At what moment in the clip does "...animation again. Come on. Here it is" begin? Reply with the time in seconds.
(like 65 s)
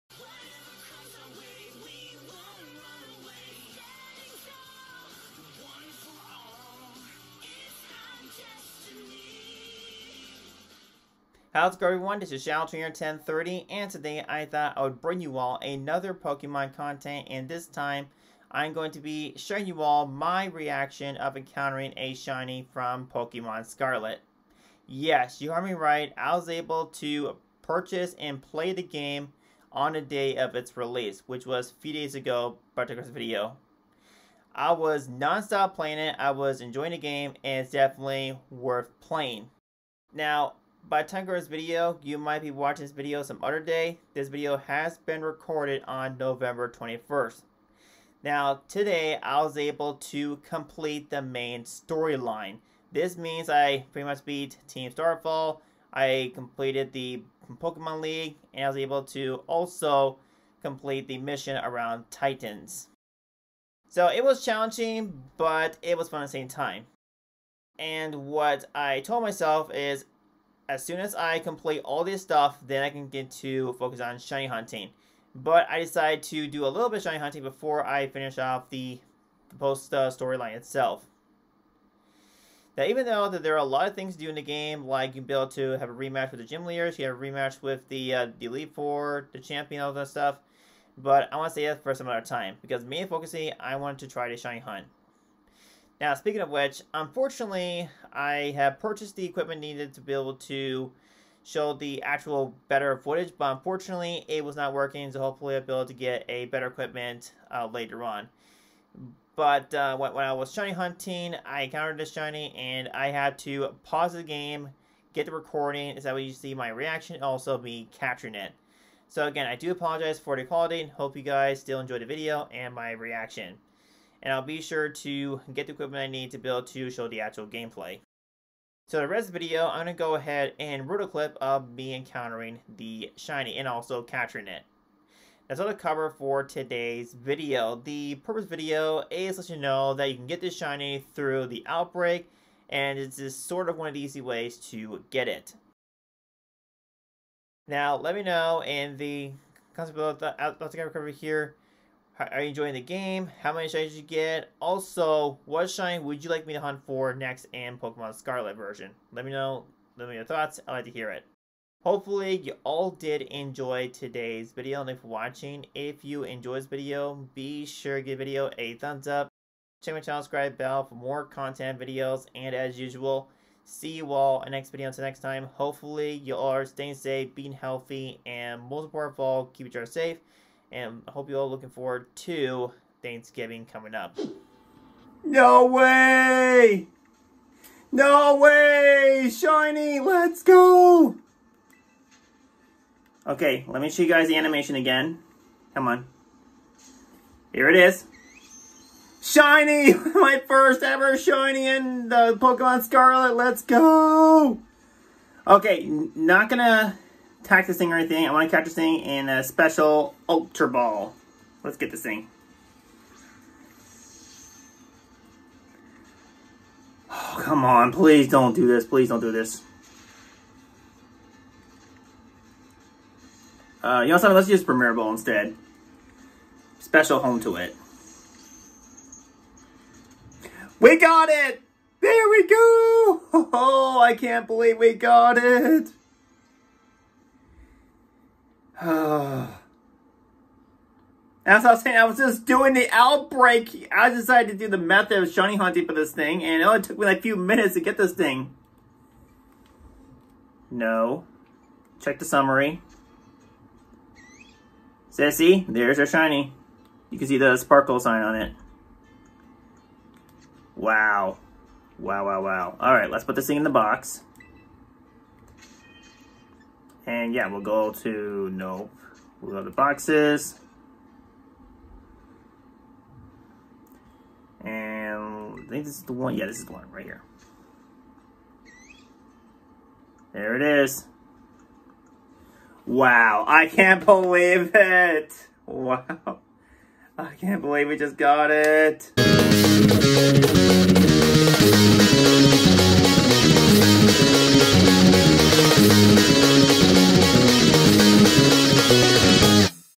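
194 s.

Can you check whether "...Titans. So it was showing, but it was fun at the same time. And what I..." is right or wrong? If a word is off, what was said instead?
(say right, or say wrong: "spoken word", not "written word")
wrong: "challenging", not "showing".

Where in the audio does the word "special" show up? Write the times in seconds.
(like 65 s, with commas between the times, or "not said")
209 s, 226 s.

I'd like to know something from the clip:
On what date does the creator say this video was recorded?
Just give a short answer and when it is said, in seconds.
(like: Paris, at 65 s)
November 21st, at 46 s.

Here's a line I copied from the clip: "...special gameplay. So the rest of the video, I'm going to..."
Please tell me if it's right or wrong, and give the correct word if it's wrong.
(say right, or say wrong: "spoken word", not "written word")
wrong: "actual", not "special".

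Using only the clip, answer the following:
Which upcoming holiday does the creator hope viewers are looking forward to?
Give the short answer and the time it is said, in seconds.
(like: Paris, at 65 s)
Thanksgiving, at 183 s.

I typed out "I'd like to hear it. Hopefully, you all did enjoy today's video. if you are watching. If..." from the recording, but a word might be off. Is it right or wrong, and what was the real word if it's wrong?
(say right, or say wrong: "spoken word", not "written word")
right.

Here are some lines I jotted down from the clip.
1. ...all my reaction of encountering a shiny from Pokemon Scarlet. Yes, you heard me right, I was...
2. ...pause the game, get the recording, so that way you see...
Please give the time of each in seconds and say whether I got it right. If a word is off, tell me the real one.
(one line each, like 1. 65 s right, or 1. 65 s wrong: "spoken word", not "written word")
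1. 19 s right
2. 113 s right.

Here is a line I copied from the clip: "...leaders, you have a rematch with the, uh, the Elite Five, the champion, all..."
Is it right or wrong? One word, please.
wrong.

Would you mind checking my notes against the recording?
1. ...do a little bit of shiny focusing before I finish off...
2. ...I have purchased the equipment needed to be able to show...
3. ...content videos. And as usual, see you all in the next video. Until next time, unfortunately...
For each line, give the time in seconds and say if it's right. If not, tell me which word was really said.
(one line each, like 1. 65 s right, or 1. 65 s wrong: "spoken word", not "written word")
1. 76 s wrong: "hunting", not "focusing"
2. 98 s right
3. 171 s wrong: "hopefully", not "unfortunately".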